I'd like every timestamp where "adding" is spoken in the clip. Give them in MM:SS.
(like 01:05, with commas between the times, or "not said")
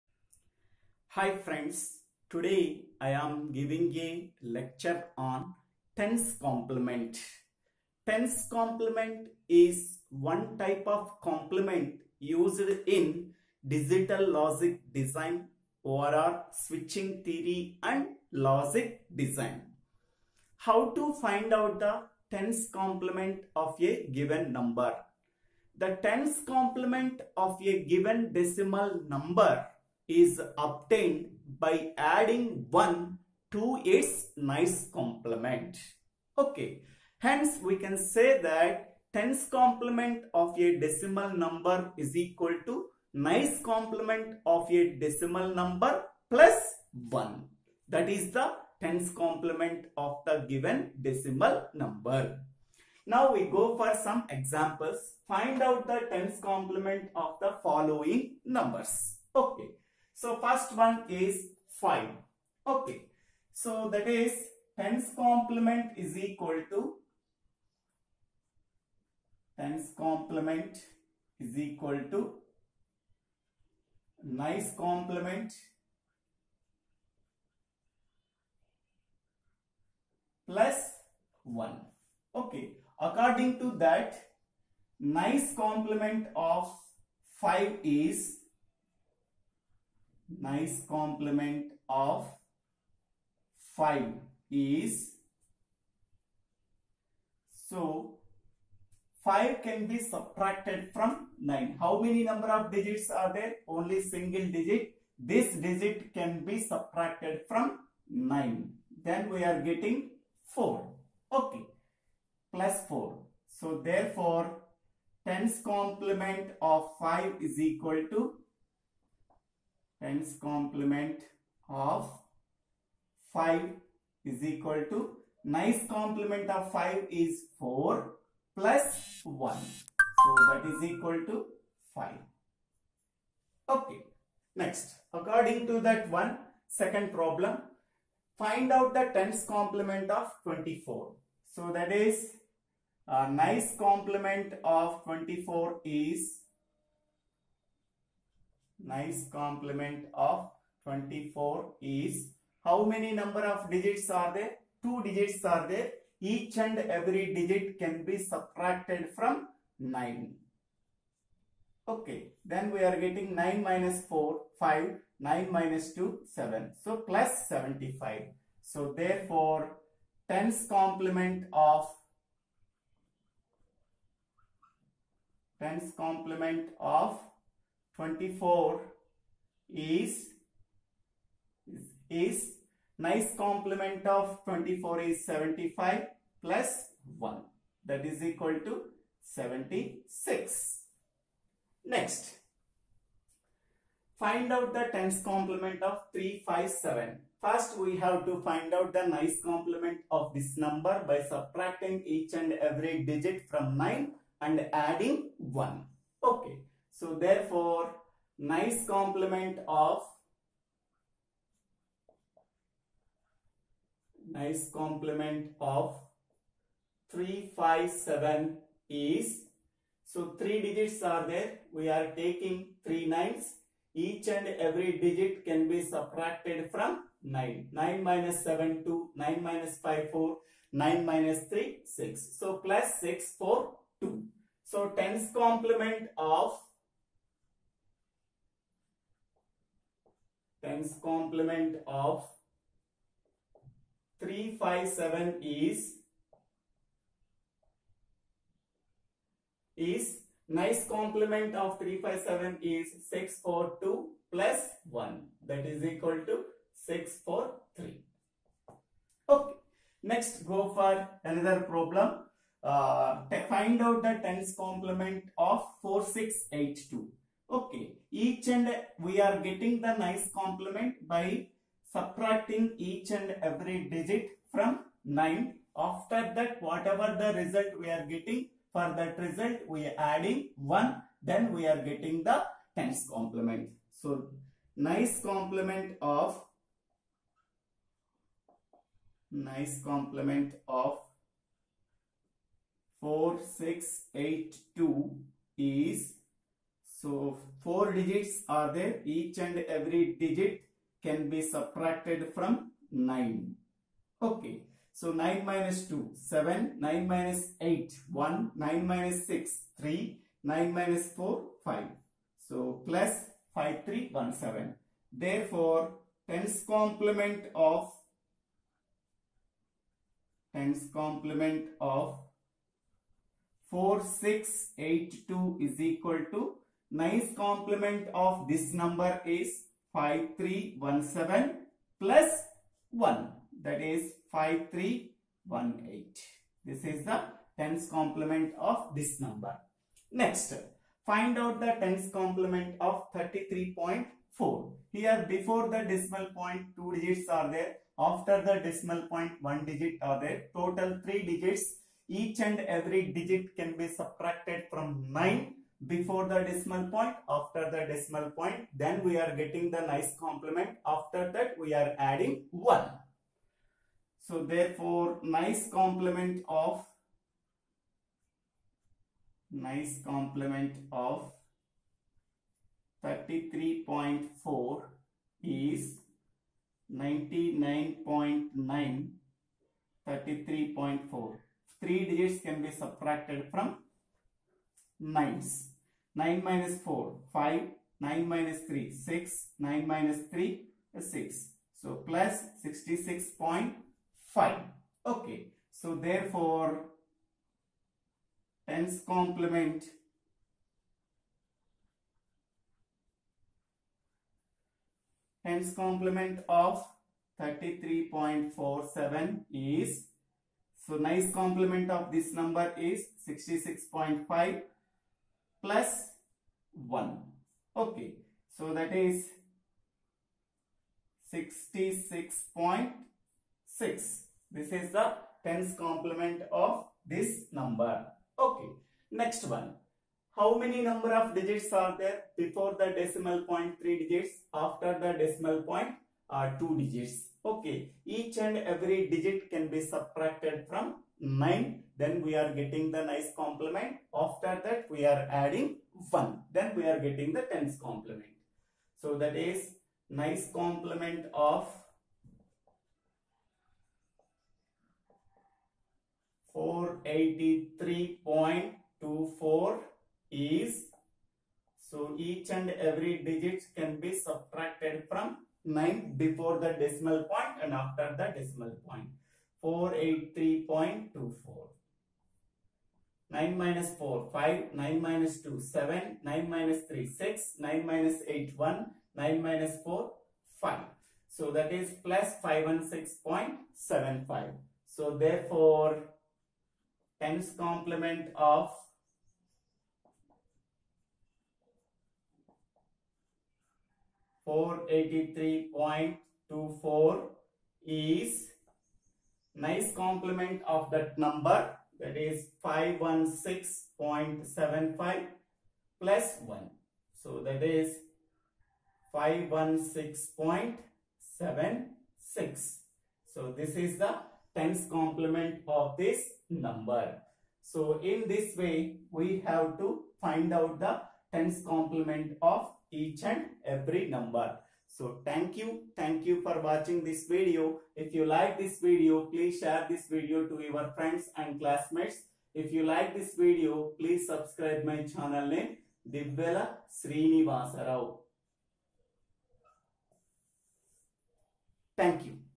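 00:31, 03:24, 04:39, 06:01, 07:25.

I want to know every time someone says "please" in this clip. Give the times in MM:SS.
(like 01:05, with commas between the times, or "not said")
08:49, 08:53.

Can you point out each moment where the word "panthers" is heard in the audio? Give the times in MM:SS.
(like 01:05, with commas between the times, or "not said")
not said.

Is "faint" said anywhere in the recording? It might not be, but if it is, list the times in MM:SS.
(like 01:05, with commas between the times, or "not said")
not said.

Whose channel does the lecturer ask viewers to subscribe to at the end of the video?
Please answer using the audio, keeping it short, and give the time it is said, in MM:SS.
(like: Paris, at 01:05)
Divvela Srinivasarao, at 08:56.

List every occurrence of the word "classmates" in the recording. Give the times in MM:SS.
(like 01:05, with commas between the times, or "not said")
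08:51.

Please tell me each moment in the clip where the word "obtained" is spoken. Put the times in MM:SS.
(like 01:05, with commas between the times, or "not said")
00:30.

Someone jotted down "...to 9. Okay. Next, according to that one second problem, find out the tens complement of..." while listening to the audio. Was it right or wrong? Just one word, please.
wrong.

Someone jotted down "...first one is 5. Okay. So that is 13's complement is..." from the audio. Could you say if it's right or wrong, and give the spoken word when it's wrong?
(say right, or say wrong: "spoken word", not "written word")
wrong: "10", not "13".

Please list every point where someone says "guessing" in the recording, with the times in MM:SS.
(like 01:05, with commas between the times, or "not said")
not said.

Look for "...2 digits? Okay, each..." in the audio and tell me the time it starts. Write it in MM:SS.
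07:16.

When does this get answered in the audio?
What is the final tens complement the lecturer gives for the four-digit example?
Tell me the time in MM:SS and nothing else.
05:34.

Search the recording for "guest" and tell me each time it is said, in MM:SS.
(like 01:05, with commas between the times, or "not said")
not said.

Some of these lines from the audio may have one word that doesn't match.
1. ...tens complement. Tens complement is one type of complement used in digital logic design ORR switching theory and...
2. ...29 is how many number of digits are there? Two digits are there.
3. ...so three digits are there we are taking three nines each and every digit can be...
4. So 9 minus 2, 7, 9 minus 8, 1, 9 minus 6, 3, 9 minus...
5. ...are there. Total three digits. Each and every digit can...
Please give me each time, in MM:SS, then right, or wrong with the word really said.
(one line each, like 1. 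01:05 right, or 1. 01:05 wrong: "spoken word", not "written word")
1. 00:05 right
2. 02:30 wrong: "24", not "29"
3. 03:40 right
4. 05:04 right
5. 05:50 right.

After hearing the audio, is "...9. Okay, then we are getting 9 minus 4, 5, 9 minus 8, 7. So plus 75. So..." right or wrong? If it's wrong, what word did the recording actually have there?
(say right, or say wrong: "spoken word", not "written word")
wrong: "2", not "8".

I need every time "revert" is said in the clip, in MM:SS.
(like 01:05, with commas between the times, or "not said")
not said.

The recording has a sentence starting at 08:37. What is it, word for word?
So in this way we have to find out the tens complement of each and every number.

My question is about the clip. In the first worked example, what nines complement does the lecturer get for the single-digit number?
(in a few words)
4.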